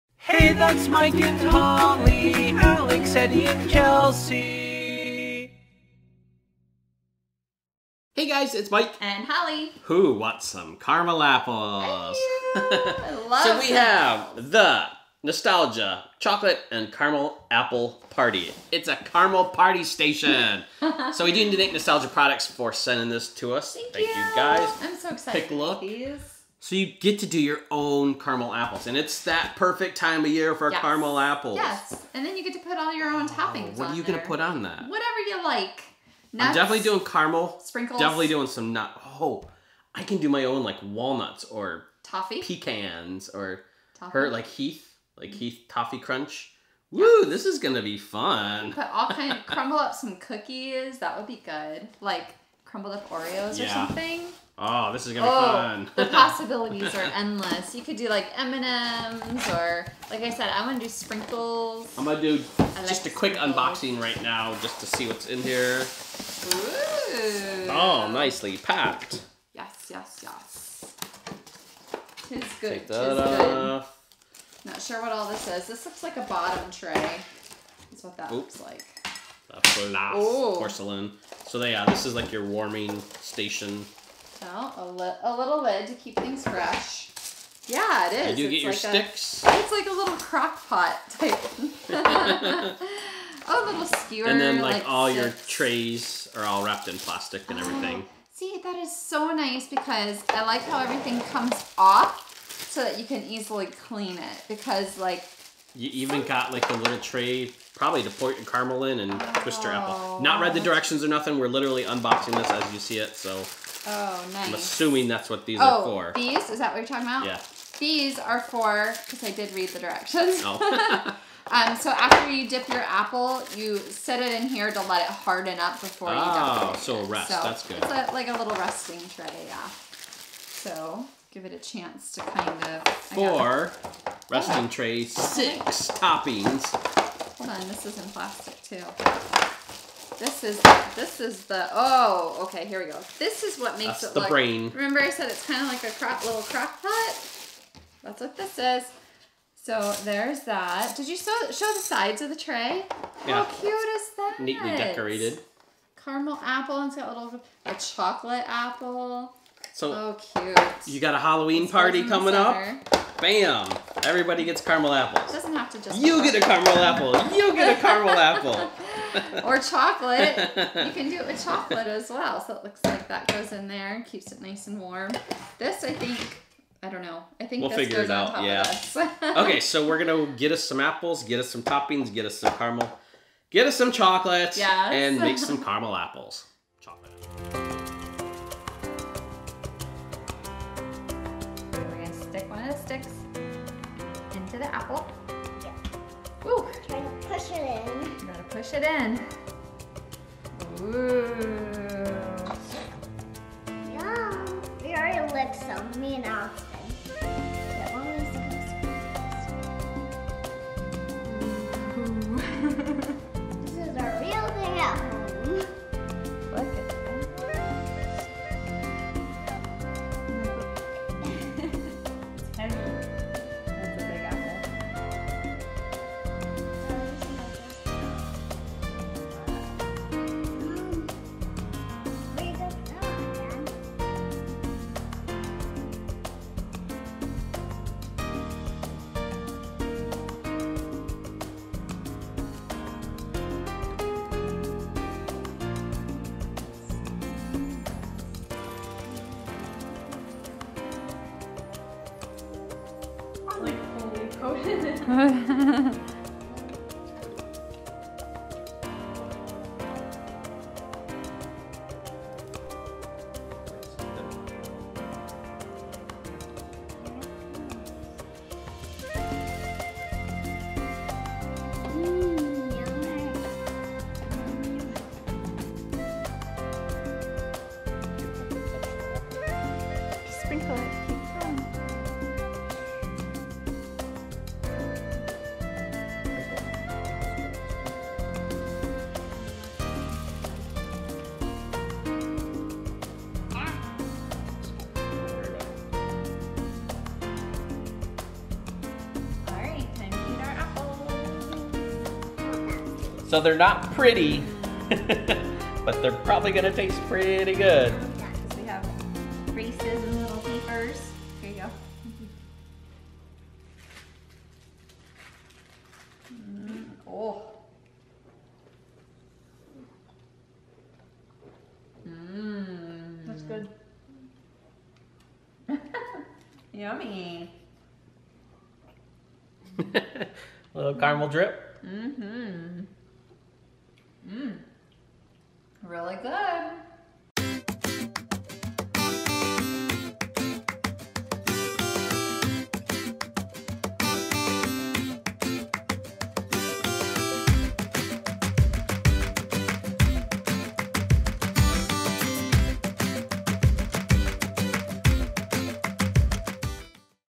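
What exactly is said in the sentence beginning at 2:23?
This is what makes That's it the look, brain.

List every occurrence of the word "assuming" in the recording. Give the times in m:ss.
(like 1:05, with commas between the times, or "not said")
1:54.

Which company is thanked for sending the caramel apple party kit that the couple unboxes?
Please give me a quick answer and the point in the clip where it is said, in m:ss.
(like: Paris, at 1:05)
Nostalgia Products, at 0:21.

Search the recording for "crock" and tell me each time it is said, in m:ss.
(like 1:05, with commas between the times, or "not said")
1:30, 2:26.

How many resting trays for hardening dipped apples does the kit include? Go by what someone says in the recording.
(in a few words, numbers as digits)
4.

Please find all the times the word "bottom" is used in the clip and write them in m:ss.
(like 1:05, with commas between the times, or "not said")
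1:16.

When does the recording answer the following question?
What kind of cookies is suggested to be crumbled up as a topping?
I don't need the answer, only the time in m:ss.
0:53.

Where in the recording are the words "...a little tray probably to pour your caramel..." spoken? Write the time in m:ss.
1:46.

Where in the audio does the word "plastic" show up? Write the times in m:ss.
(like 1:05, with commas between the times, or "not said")
1:36, 2:18.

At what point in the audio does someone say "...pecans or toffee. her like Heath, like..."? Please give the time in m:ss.
0:42.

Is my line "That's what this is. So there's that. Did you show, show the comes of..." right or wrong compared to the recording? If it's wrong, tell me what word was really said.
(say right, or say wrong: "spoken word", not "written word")
wrong: "sides", not "comes".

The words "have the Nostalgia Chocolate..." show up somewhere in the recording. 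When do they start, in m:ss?
0:13.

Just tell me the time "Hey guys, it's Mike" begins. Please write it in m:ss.
0:08.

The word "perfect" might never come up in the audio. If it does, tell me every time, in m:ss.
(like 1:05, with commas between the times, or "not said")
0:29.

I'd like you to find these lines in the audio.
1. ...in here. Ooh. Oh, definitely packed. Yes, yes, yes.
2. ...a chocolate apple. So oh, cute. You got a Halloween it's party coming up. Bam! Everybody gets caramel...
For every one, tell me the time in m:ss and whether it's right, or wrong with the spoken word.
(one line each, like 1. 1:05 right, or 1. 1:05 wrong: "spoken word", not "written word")
1. 1:05 wrong: "nicely", not "definitely"
2. 2:37 right.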